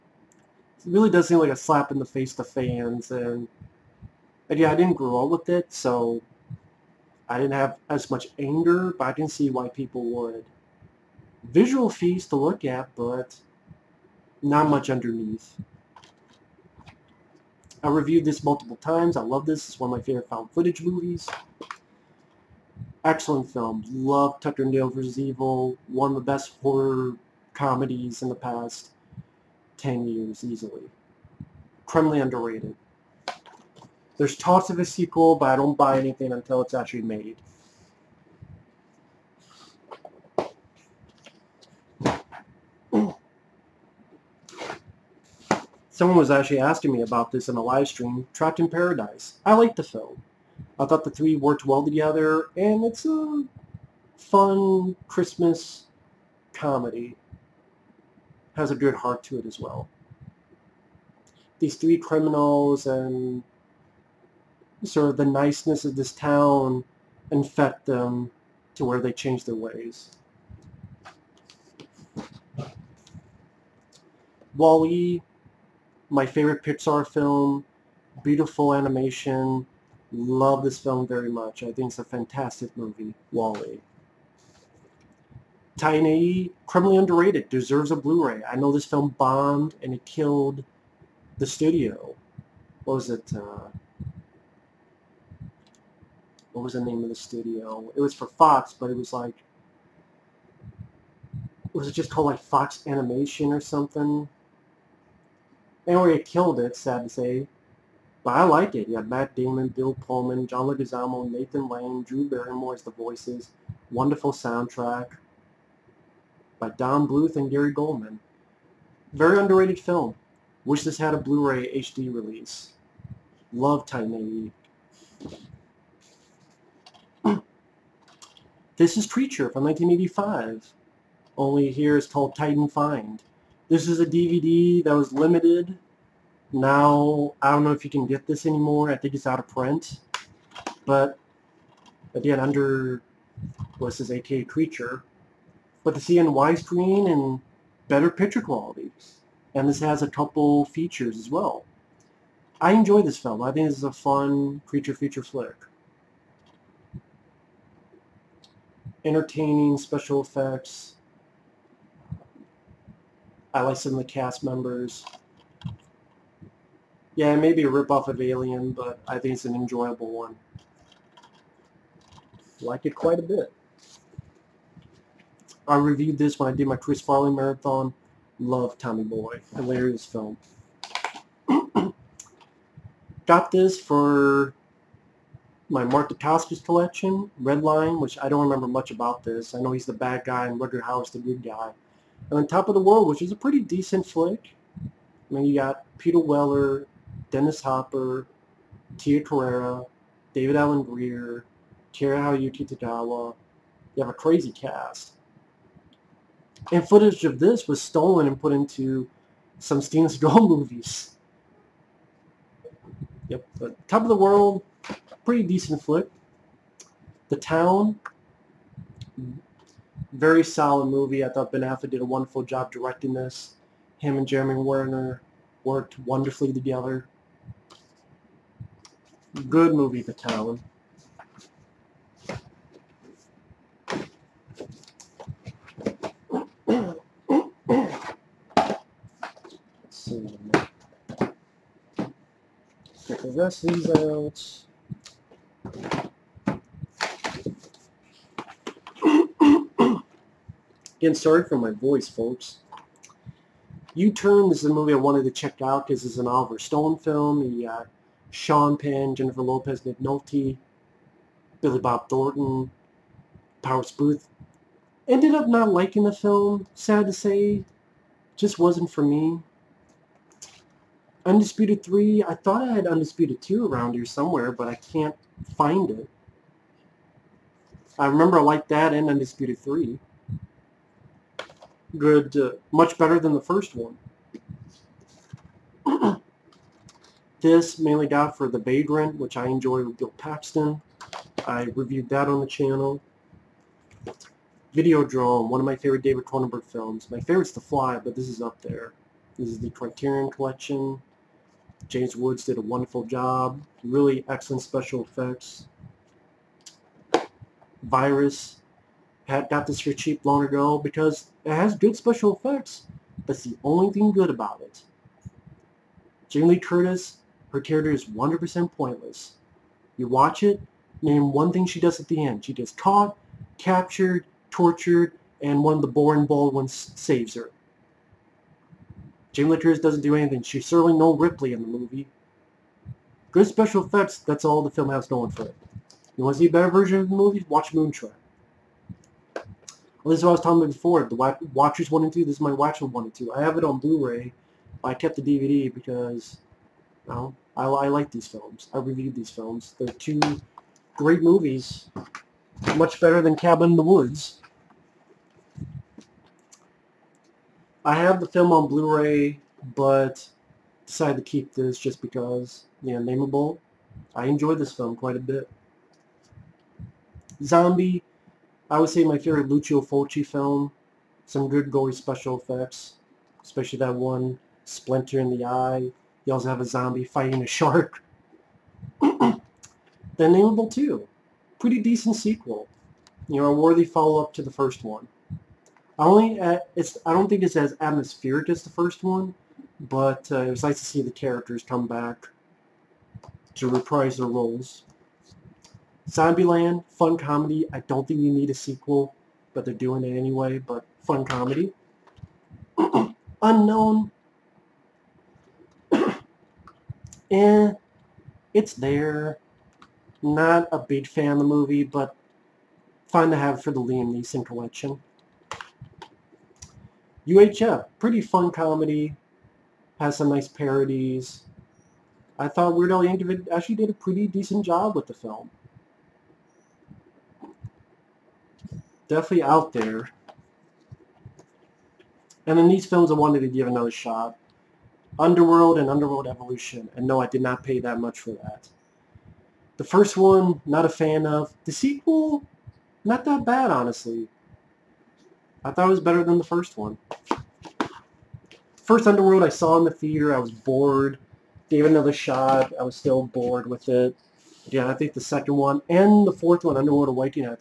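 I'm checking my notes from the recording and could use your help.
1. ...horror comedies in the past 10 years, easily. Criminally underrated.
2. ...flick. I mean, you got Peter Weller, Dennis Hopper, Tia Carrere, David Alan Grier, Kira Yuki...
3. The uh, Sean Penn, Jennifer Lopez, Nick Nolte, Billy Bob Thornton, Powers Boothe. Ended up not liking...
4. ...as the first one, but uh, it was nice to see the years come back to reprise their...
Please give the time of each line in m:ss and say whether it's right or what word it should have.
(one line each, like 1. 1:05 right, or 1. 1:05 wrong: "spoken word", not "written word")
1. 0:26 right
2. 3:14 right
3. 4:17 right
4. 6:28 wrong: "characters", not "years".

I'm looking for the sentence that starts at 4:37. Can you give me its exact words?
I remember I liked that and Undisputed 3 good, uh, much better than the first one.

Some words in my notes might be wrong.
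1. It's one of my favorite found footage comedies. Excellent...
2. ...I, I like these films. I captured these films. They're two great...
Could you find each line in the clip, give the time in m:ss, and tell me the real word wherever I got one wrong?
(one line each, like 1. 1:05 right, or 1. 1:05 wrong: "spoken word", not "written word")
1. 0:19 wrong: "movies", not "comedies"
2. 5:47 wrong: "reviewed", not "captured".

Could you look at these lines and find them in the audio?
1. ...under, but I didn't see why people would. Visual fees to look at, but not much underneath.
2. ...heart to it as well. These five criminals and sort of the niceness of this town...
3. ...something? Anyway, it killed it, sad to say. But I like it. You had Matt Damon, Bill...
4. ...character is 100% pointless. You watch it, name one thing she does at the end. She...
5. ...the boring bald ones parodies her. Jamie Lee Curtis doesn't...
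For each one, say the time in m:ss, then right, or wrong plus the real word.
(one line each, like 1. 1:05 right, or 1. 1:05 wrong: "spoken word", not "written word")
1. 0:08 wrong: "anger", not "under"
2. 0:58 wrong: "three", not "five"
3. 1:43 right
4. 5:17 right
5. 5:25 wrong: "saves", not "parodies".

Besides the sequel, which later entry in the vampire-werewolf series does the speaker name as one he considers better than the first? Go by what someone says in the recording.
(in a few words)
Underworld Awakening.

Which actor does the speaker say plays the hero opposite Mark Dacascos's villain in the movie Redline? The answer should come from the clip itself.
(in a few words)
Rutger Hauer.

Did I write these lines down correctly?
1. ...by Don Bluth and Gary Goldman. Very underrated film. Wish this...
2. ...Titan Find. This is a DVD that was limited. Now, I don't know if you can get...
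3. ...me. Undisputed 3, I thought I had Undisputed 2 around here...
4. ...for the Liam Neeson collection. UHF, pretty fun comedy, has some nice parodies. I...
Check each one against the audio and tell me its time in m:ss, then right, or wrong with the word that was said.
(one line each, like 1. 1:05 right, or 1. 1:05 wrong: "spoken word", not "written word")
1. 1:56 right
2. 2:12 right
3. 4:29 right
4. 6:53 right.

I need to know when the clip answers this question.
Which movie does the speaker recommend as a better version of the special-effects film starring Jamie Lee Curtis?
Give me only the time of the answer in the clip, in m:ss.
5:37.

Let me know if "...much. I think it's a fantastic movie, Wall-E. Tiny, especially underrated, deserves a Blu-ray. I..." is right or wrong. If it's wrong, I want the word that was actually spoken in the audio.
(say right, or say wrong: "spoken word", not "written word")
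wrong: "criminally", not "especially".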